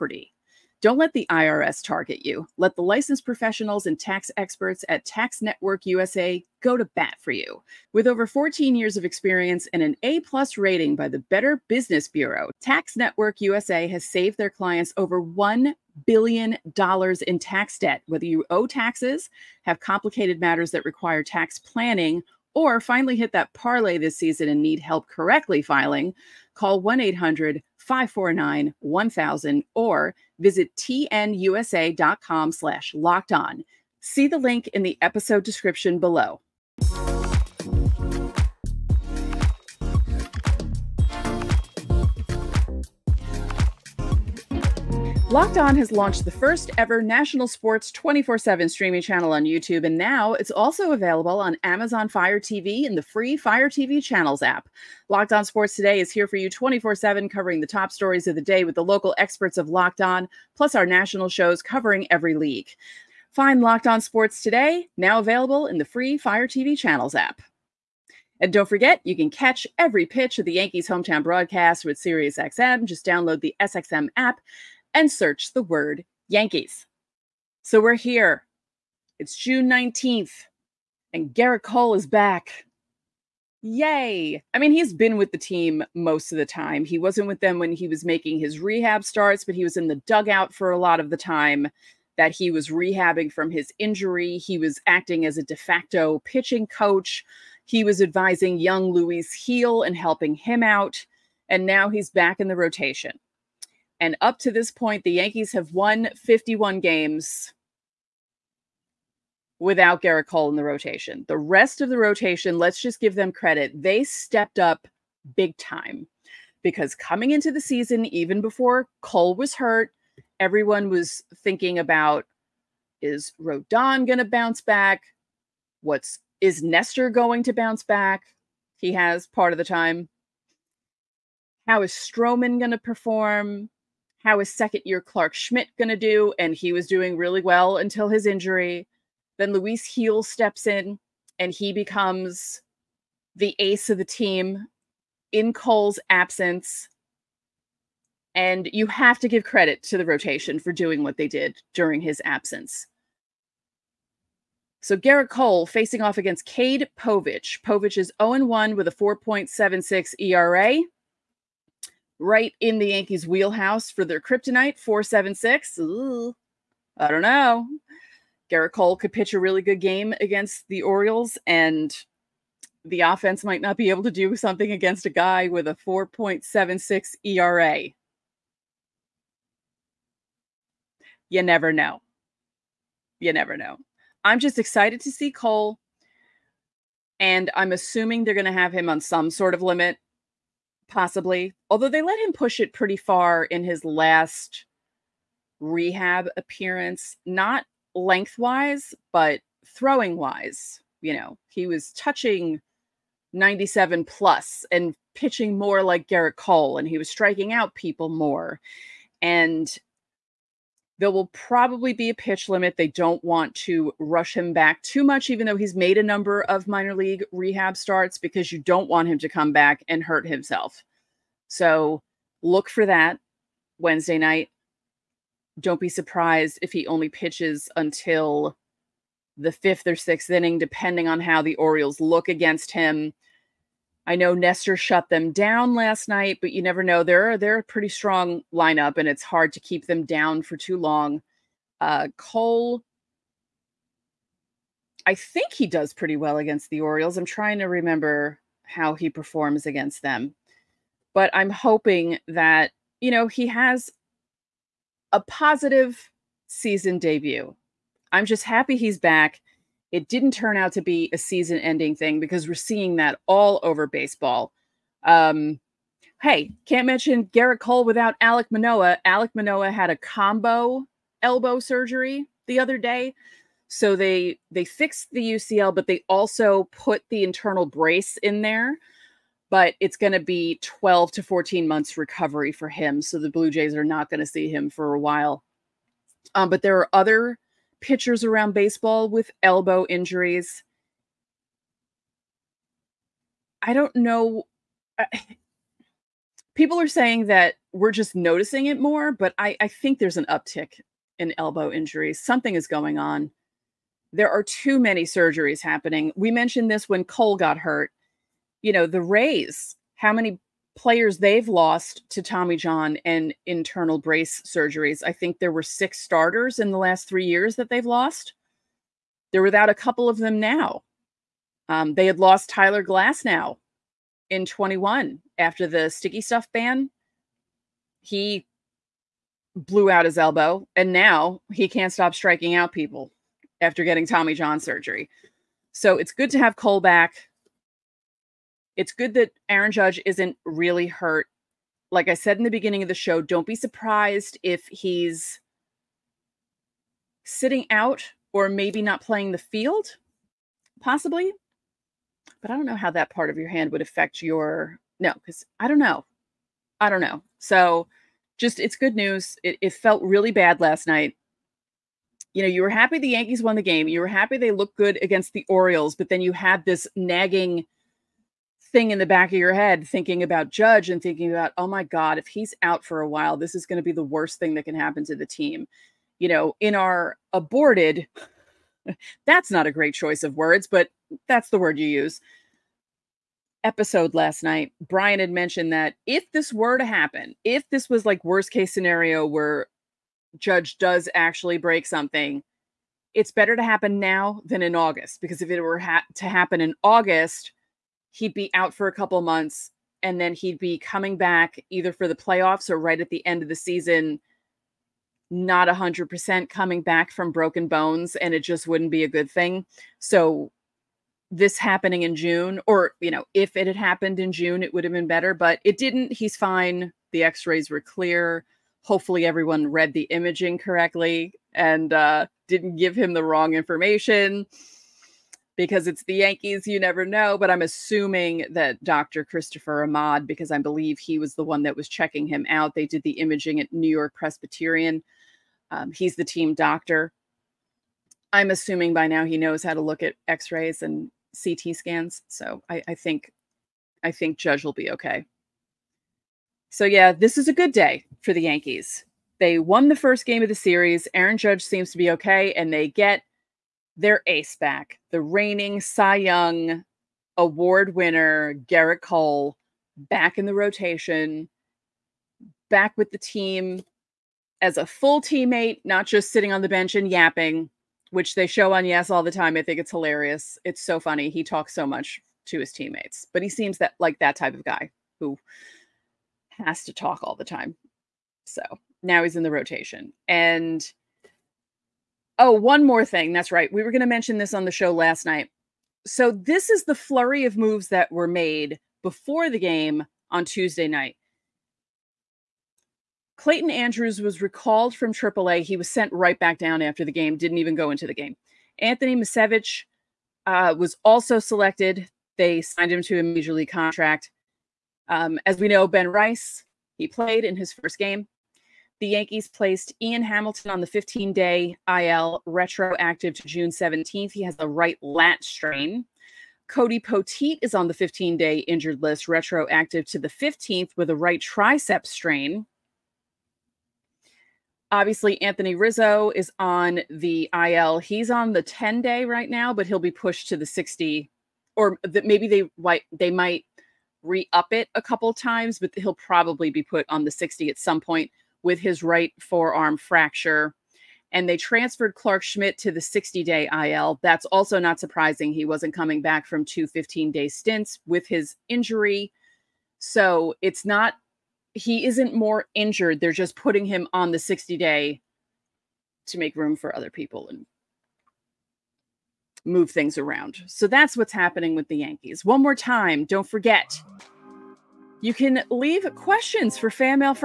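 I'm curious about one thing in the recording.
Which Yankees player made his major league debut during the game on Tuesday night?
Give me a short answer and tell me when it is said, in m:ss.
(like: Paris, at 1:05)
Ben Rice, at 8:25.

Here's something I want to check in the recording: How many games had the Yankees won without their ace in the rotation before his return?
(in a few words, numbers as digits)
51.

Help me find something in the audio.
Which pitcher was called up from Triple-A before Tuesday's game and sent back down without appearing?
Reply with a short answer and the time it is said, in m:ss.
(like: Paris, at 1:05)
Clayton Andrews, at 8:13.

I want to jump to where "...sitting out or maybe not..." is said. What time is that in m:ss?
5:47.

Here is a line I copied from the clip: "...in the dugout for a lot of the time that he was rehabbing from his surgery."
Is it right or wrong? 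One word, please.
wrong.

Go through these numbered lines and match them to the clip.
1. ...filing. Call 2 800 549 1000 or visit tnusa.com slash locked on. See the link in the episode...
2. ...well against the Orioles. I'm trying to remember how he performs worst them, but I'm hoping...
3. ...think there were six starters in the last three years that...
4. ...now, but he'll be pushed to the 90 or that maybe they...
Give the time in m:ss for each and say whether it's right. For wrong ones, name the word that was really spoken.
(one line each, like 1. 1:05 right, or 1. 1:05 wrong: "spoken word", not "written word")
1. 0:25 wrong: "1", not "2"
2. 4:06 wrong: "against", not "worst"
3. 5:15 right
4. 8:49 wrong: "60", not "90".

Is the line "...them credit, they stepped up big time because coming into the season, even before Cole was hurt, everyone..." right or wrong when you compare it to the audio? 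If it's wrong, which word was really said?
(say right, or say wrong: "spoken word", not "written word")
right.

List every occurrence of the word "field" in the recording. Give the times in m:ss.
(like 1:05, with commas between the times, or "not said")
5:49.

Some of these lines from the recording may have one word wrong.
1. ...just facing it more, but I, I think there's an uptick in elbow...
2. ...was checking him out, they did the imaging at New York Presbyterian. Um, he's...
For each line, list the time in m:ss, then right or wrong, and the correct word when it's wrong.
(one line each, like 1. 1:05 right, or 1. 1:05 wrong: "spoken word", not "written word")
1. 4:57 wrong: "noticing", not "facing"
2. 7:11 right.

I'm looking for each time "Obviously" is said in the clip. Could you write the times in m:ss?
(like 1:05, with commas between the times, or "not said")
8:44.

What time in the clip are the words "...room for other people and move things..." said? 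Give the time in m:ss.
9:16.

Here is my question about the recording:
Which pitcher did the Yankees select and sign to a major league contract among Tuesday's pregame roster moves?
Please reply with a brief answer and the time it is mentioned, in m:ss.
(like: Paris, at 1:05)
Anthony Misiewicz, at 8:18.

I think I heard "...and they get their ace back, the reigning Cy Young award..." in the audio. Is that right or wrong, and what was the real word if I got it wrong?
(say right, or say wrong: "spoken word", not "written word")
right.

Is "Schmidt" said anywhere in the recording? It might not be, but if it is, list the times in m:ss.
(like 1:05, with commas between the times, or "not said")
2:15, 9:02.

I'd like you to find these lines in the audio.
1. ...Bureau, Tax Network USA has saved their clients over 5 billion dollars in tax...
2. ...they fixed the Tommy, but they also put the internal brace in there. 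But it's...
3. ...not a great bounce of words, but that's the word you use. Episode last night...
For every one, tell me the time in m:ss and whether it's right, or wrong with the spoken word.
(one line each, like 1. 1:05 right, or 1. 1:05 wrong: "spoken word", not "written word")
1. 0:12 wrong: "1", not "5"
2. 4:34 wrong: "UCL", not "Tommy"
3. 6:19 wrong: "choice", not "bounce".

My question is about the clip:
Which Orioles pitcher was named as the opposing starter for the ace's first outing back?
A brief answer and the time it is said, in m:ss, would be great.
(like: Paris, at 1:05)
Cade Povich, at 2:36.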